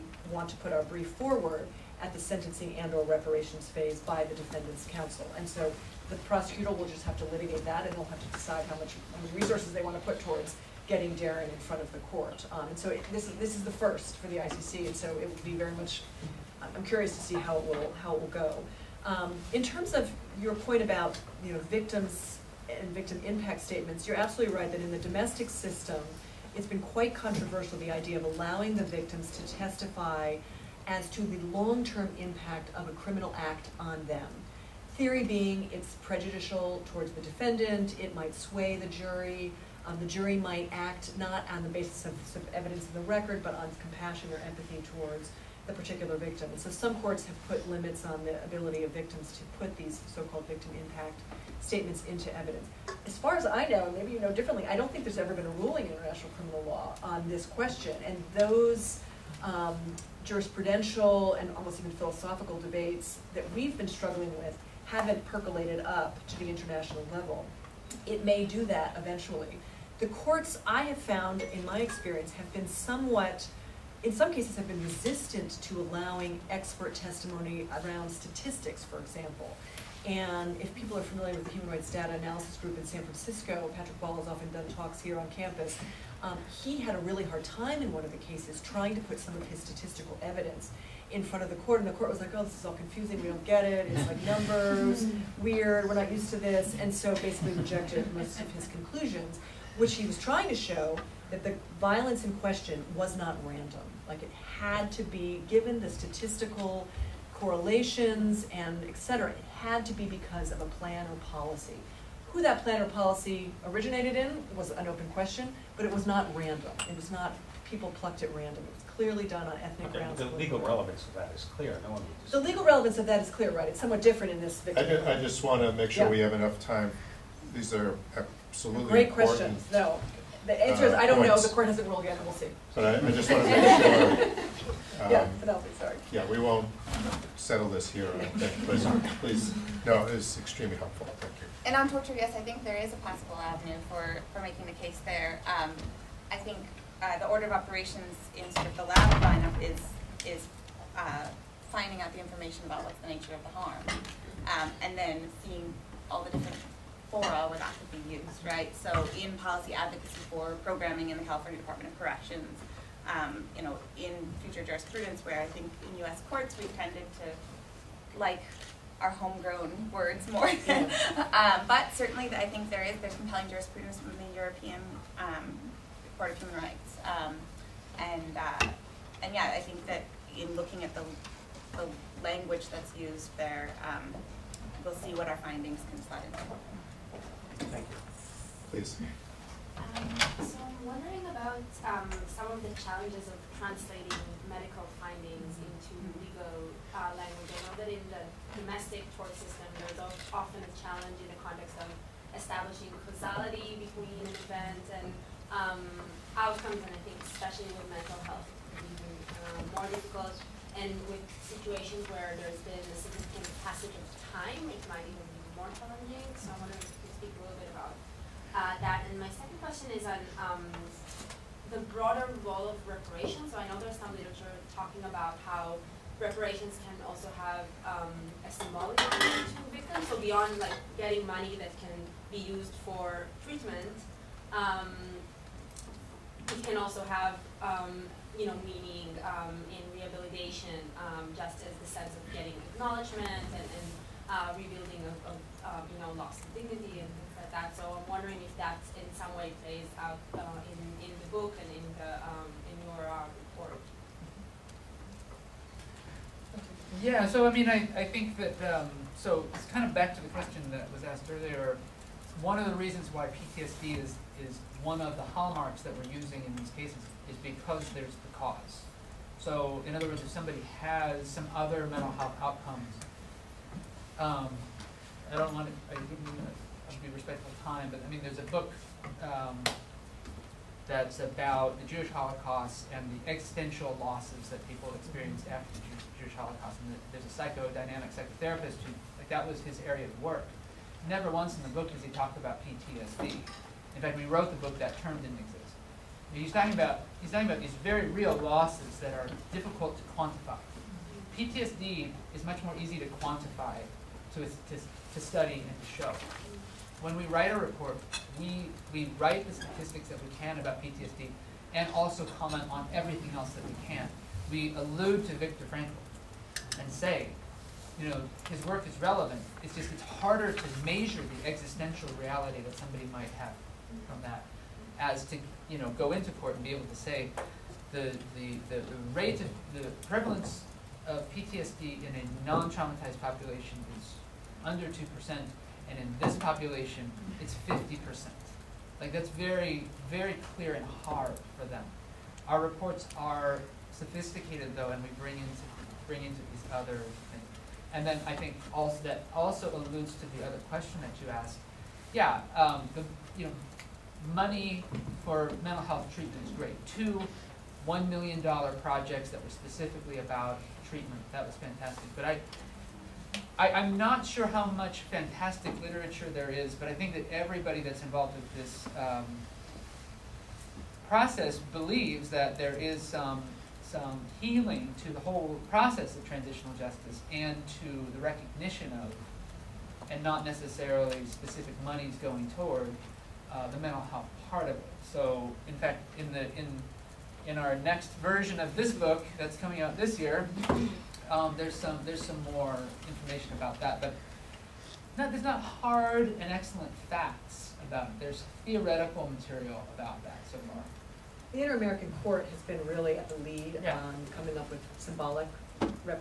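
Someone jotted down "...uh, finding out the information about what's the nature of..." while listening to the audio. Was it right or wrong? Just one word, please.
right.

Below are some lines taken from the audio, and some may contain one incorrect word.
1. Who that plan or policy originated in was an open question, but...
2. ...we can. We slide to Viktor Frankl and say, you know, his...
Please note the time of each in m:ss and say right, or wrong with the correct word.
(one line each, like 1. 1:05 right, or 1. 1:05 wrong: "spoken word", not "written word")
1. 1:52 right
2. 5:13 wrong: "allude", not "slide".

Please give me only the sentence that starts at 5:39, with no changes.
Like that's very, very clear and hard for them.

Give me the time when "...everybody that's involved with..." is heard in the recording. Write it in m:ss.
6:07.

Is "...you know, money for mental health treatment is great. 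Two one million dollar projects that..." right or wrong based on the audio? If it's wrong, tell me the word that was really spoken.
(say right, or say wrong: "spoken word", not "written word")
right.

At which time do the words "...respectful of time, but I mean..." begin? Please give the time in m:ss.
4:37.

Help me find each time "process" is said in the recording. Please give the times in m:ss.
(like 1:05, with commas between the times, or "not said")
6:11, 6:15.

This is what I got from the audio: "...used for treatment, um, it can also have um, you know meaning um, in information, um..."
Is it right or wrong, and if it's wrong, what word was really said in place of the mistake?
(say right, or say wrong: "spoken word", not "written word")
wrong: "rehabilitation", not "information".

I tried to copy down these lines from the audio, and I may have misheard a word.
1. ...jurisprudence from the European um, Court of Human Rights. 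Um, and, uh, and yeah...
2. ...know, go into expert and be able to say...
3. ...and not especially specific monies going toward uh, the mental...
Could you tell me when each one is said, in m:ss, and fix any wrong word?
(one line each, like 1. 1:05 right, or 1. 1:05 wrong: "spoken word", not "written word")
1. 2:53 right
2. 5:25 wrong: "court", not "expert"
3. 6:20 wrong: "necessarily", not "especially".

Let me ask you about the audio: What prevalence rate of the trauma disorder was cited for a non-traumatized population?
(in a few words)
Under 2%.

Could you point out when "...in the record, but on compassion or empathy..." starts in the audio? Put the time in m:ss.
0:42.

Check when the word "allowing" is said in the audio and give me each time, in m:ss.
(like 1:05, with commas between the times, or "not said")
0:28, 1:15.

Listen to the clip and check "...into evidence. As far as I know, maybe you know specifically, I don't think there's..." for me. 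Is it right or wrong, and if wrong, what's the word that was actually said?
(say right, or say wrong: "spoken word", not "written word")
wrong: "differently", not "specifically".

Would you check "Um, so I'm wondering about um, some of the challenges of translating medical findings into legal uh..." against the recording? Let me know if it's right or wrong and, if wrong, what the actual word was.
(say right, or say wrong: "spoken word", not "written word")
right.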